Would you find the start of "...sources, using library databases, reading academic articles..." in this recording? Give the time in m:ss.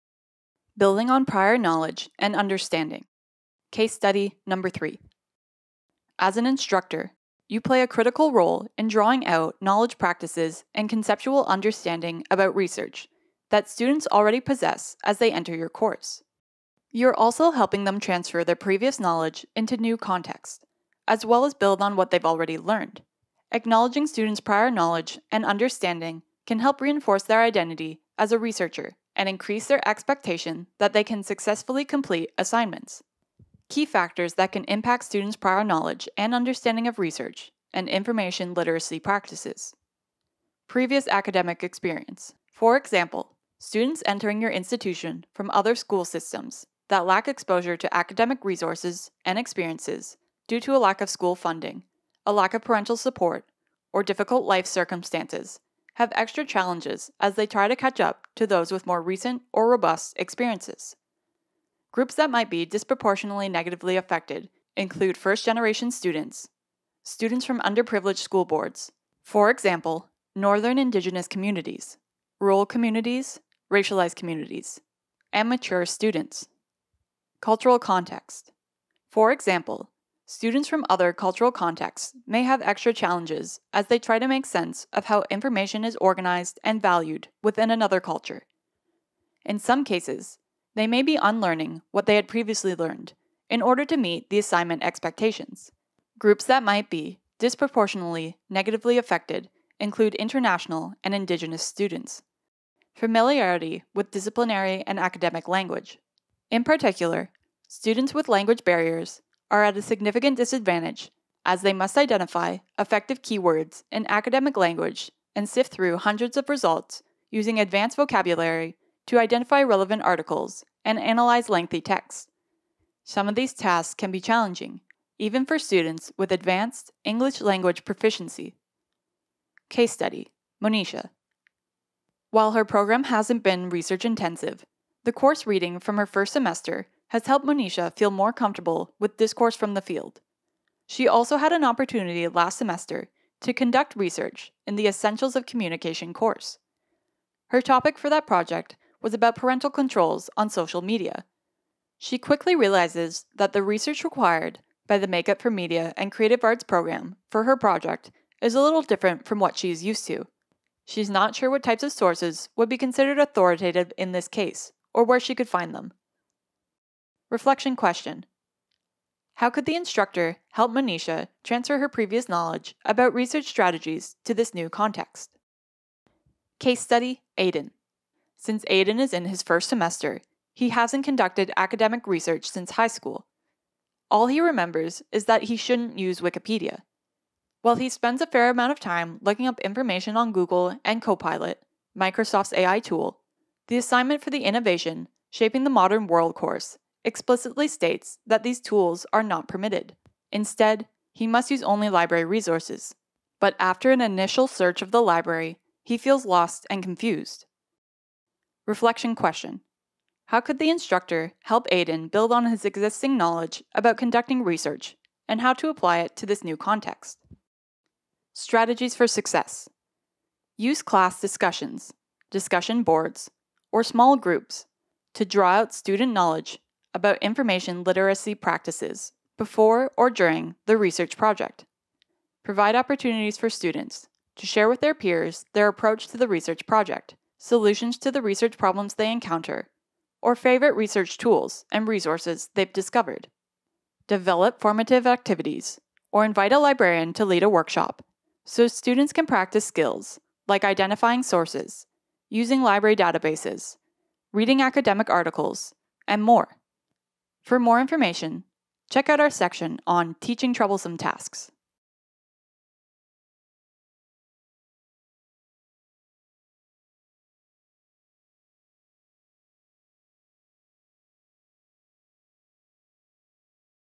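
4:11.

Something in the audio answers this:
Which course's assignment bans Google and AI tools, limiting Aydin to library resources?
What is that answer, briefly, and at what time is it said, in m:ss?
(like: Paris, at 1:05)
Innovation Shaping the Modern World, at 3:14.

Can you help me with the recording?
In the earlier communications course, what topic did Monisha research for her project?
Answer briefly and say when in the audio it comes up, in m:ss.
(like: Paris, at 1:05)
Parental controls on social media, at 2:29.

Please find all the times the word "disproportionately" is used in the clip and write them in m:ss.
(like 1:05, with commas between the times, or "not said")
1:02, 1:37.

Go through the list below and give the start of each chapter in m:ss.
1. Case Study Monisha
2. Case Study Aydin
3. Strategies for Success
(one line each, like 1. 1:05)
1. 2:10
2. 2:53
3. 3:38.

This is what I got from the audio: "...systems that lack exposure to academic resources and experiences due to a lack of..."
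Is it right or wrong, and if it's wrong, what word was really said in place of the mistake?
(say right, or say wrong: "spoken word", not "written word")
right.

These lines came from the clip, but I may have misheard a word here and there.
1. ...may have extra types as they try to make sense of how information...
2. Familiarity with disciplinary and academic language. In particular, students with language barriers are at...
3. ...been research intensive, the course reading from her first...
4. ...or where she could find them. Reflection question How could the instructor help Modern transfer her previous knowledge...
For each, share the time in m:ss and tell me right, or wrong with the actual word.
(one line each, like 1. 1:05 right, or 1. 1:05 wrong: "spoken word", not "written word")
1. 1:22 wrong: "challenges", not "types"
2. 1:42 right
3. 2:13 right
4. 2:44 wrong: "Monisha", not "Modern".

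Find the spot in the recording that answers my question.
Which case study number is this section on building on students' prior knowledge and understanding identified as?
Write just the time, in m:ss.
0:04.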